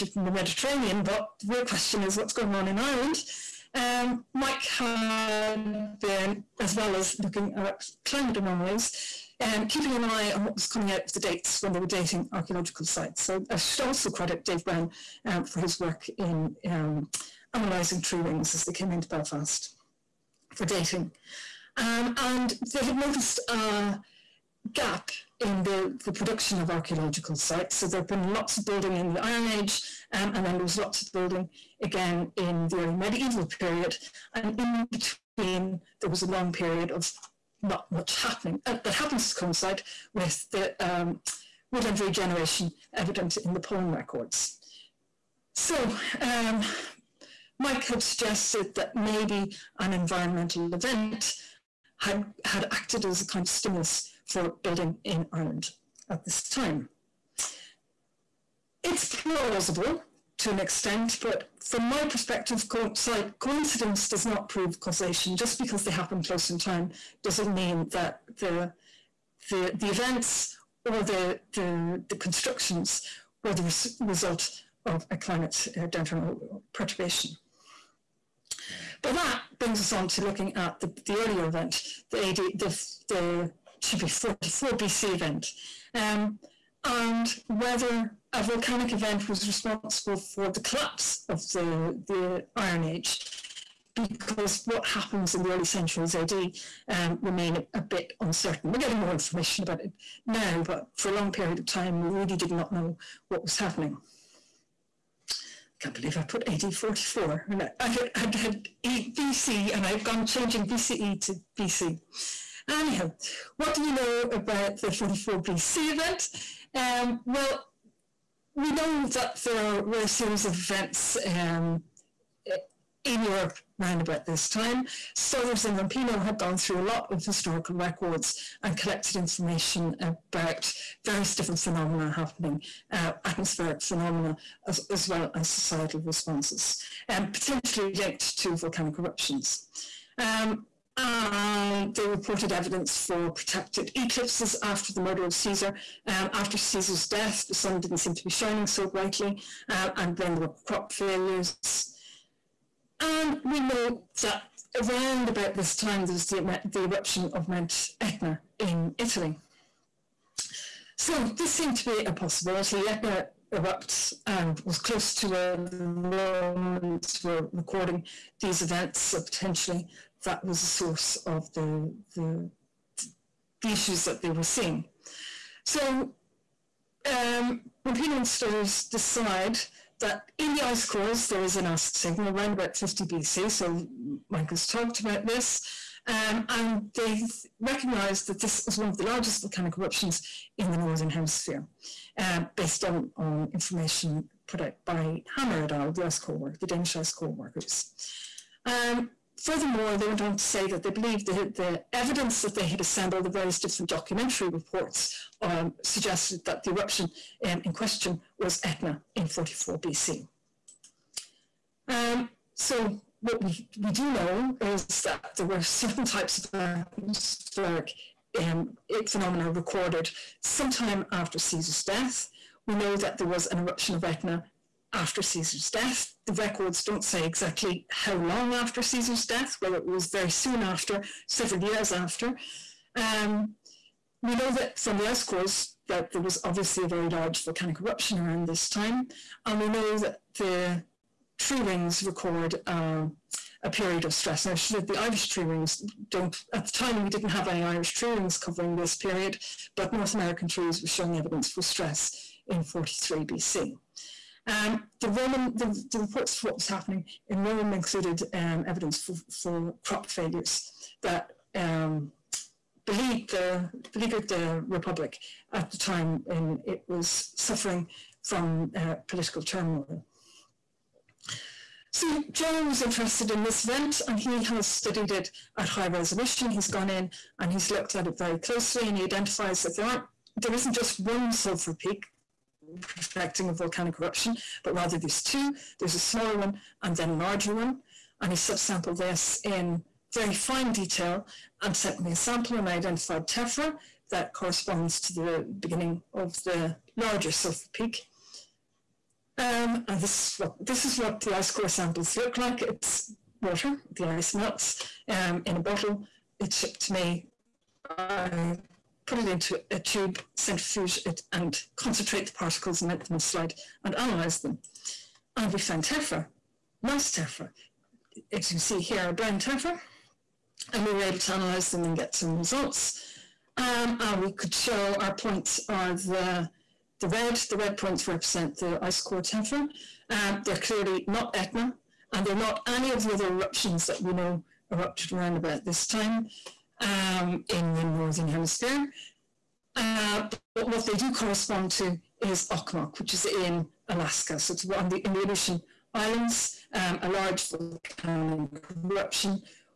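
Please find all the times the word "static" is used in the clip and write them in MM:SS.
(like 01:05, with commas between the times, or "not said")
not said.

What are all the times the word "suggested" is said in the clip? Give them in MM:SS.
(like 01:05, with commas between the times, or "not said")
00:48, 03:25.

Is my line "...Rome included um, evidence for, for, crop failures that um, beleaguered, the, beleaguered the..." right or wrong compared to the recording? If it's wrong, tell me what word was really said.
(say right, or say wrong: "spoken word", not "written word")
right.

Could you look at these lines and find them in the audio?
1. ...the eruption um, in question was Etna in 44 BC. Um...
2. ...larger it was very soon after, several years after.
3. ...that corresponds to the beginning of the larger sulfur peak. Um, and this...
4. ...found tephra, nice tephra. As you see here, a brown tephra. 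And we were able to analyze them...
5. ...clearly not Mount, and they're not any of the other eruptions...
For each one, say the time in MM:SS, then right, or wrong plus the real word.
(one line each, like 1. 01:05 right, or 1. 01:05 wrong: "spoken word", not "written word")
1. 03:26 right
2. 03:49 wrong: "whether", not "larger"
3. 04:54 right
4. 05:15 right
5. 05:30 wrong: "Etna", not "Mount".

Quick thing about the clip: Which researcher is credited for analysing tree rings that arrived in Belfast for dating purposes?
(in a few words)
Dave Brown.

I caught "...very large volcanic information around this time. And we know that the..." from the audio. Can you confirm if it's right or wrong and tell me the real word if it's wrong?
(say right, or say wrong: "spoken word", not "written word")
wrong: "eruption", not "information".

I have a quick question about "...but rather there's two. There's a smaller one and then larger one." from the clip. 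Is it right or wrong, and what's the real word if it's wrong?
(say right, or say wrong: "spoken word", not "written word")
right.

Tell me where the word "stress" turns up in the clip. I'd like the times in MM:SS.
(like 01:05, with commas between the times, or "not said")
04:04, 04:11.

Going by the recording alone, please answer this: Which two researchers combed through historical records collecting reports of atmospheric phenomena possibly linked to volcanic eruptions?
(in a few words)
Stothers and Rampino.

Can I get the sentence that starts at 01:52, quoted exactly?
Anyhow, what do we know about the 44 BC event?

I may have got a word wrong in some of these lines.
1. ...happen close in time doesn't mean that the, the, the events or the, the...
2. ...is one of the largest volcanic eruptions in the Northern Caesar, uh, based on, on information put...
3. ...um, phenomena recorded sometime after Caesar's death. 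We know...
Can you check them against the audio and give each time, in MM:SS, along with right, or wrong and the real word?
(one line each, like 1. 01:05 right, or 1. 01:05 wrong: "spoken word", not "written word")
1. 01:05 right
2. 03:08 wrong: "Hemisphere", not "Caesar"
3. 03:38 right.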